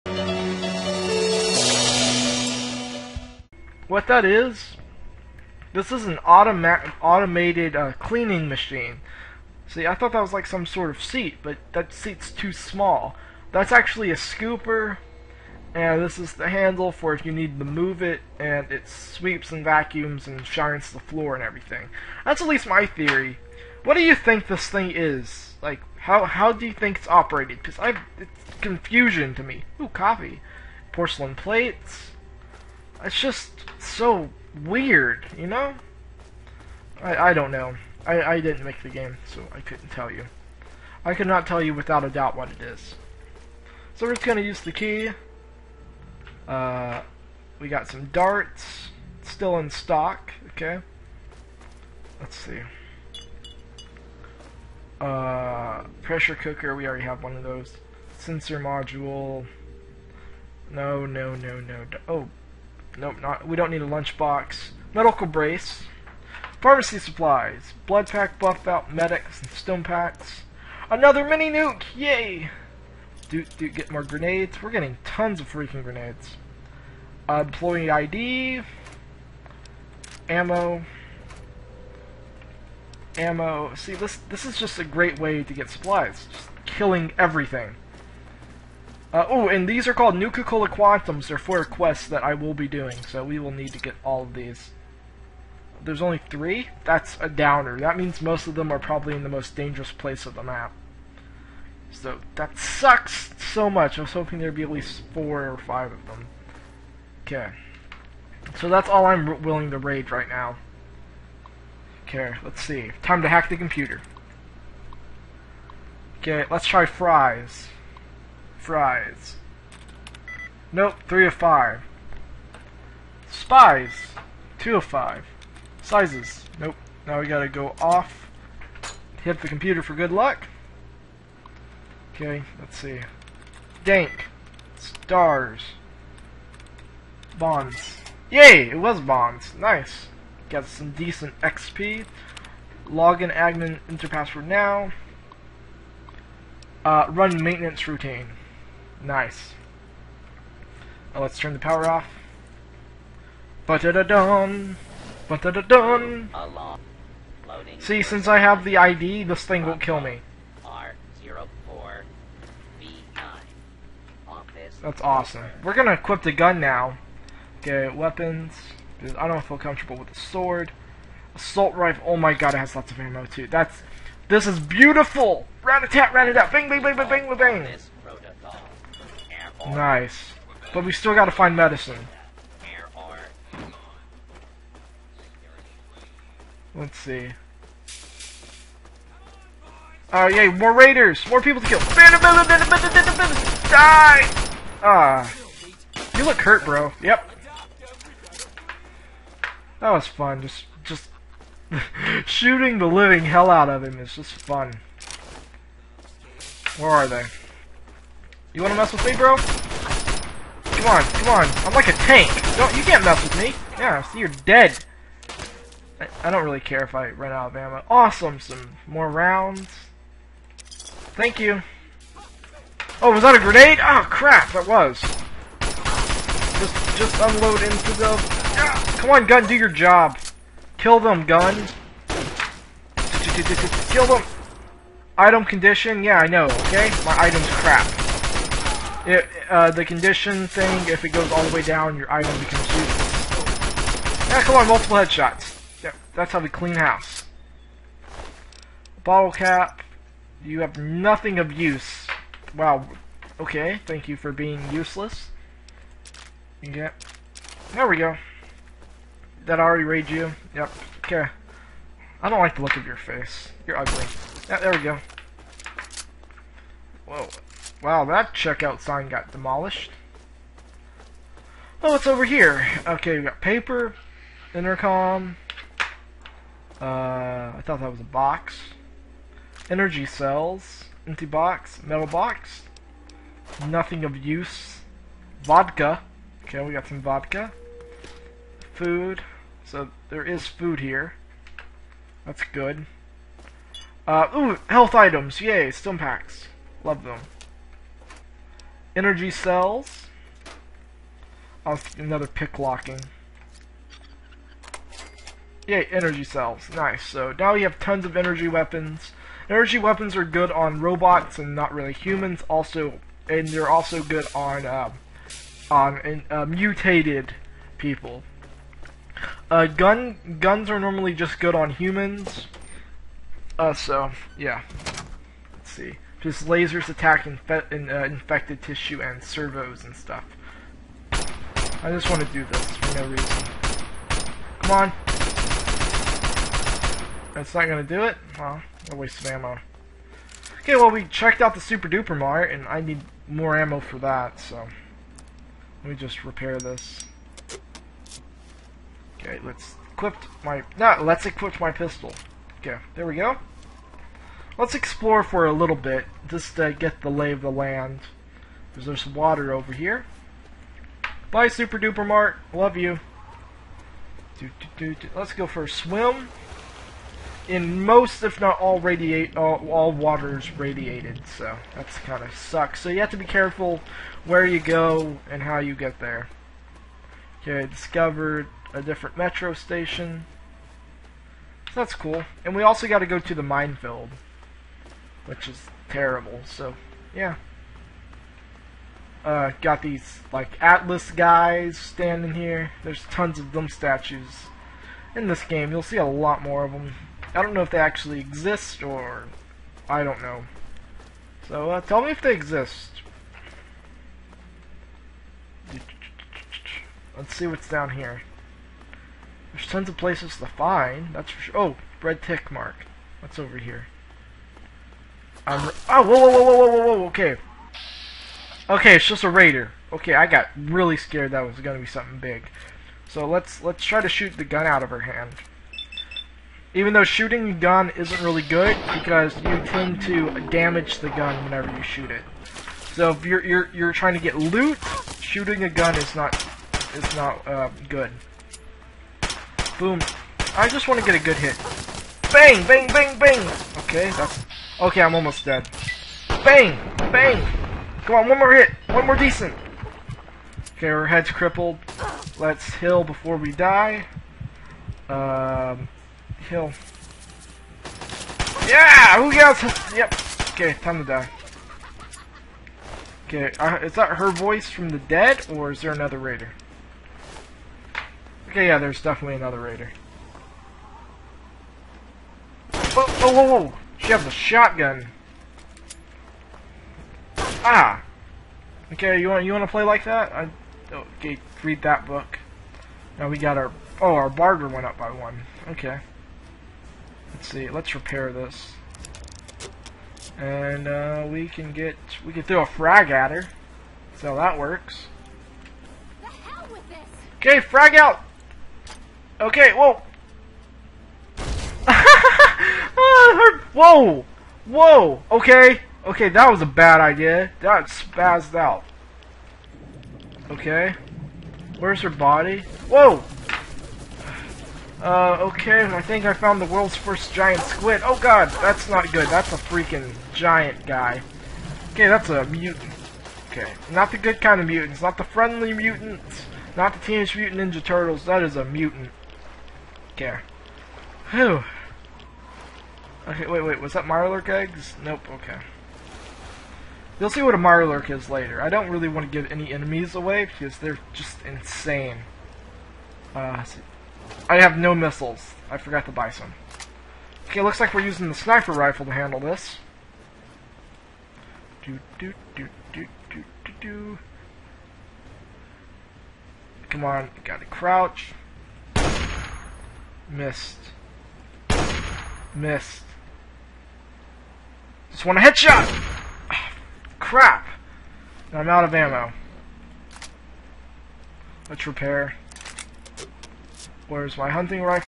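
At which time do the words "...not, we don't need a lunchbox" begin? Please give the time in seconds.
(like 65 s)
63 s.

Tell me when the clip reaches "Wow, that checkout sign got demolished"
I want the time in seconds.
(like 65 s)
267 s.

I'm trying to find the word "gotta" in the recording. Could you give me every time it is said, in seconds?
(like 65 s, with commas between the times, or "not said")
127 s, 181 s, 557 s.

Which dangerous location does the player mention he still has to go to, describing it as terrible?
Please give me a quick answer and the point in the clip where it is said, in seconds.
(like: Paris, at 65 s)
The minefield, at 383 s.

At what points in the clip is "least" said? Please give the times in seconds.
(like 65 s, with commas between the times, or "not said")
22 s, 104 s.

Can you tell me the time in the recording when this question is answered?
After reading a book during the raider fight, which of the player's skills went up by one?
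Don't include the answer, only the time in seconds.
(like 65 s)
484 s.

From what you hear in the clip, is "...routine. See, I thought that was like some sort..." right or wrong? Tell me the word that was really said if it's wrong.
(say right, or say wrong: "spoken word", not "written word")
wrong: "machine", not "routine".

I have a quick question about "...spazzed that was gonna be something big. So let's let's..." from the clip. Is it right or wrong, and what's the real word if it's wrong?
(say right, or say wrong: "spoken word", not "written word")
wrong: "scared", not "spazzed".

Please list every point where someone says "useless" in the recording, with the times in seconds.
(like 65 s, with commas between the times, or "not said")
242 s, 254 s.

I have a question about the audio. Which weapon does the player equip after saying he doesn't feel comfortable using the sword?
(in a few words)
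Assault rifle.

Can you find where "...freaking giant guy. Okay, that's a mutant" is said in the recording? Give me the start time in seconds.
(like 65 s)
519 s.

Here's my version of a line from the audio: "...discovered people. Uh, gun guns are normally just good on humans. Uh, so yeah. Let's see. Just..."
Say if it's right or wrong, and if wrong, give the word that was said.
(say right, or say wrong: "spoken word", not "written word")
wrong: "mutated", not "discovered".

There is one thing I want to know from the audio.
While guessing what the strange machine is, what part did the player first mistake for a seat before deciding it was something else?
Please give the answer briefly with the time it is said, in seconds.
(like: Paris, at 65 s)
A scooper, at 14 s.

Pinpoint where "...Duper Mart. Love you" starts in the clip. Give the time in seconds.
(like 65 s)
361 s.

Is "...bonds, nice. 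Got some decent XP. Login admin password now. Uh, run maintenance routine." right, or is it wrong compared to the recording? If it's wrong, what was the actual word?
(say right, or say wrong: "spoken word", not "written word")
right.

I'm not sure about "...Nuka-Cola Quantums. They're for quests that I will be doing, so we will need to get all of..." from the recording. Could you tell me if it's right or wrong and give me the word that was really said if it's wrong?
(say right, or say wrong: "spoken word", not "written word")
right.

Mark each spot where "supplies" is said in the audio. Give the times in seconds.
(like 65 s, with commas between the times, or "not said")
66 s, 85 s.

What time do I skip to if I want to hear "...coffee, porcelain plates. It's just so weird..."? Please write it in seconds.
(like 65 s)
29 s.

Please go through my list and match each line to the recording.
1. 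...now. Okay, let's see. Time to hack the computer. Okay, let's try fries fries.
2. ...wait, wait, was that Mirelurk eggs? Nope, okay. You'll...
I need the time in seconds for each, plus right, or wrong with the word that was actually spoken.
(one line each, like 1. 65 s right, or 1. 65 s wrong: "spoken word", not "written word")
1. 110 s right
2. 533 s right.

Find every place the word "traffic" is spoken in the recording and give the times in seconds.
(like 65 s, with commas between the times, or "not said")
not said.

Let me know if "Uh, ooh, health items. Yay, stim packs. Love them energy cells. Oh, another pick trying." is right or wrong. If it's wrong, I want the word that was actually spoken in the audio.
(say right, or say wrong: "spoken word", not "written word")
wrong: "locking", not "trying".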